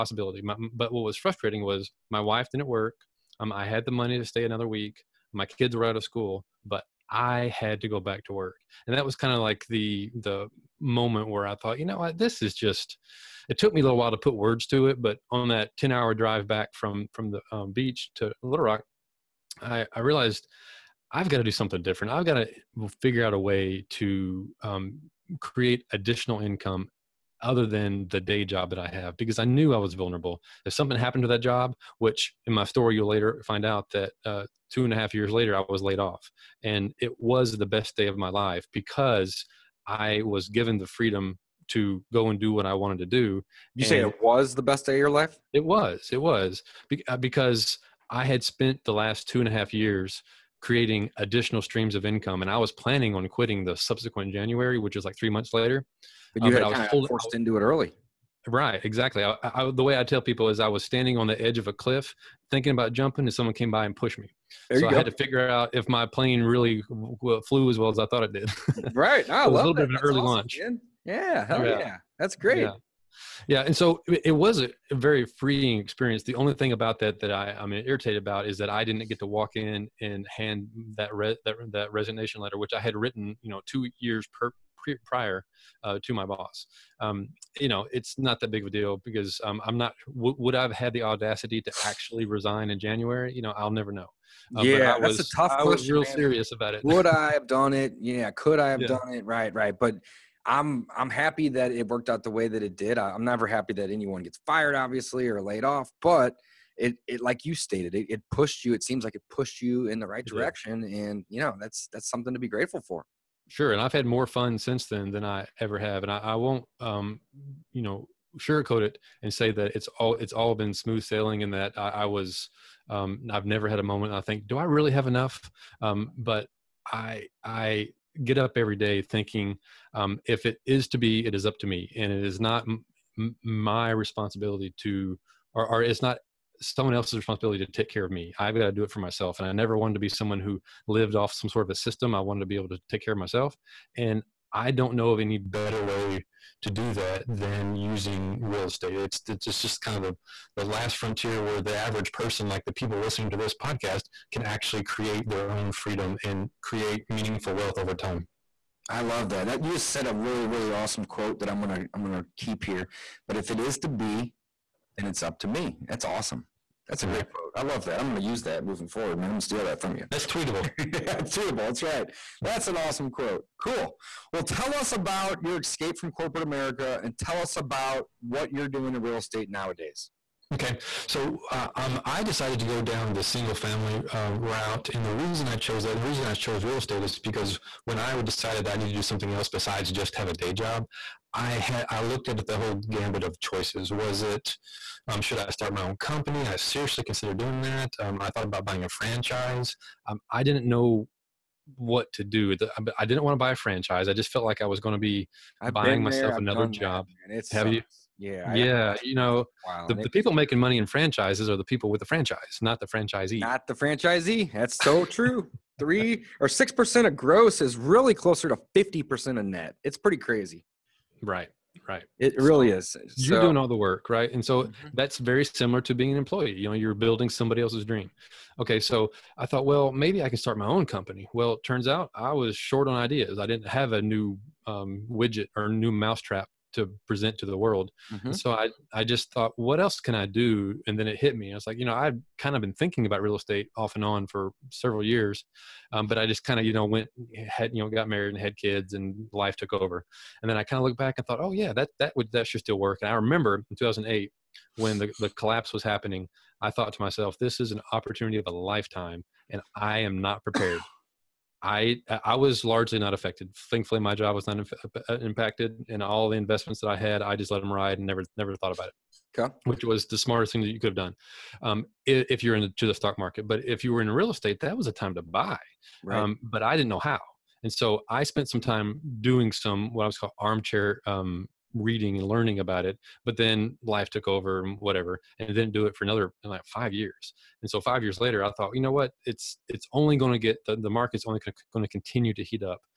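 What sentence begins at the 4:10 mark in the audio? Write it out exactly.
And then I kind of looked back and thought, oh yeah, that, that would, that should still work.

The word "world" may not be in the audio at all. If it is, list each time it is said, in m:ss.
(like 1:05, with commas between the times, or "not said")
3:57.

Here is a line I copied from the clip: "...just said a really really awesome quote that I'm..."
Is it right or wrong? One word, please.
right.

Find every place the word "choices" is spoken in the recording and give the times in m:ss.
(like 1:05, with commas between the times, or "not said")
3:13.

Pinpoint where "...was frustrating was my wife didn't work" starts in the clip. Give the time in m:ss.
0:01.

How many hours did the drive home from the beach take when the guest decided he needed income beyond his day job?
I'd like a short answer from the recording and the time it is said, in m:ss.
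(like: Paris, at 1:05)
10, at 0:15.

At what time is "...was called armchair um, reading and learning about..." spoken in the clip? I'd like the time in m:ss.
4:40.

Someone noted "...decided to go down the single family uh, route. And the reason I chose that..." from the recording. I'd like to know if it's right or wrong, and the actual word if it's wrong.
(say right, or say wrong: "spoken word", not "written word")
right.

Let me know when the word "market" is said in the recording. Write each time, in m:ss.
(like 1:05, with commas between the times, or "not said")
4:33, 4:50.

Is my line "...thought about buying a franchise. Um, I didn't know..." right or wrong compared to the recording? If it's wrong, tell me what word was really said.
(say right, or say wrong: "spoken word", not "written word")
right.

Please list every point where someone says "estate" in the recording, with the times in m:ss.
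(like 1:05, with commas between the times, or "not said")
2:28, 2:59, 3:06, 4:03, 4:34.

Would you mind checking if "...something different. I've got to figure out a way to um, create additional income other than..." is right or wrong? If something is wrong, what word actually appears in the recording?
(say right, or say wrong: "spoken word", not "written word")
right.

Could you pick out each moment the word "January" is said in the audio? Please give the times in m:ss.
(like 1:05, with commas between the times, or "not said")
0:54, 1:32.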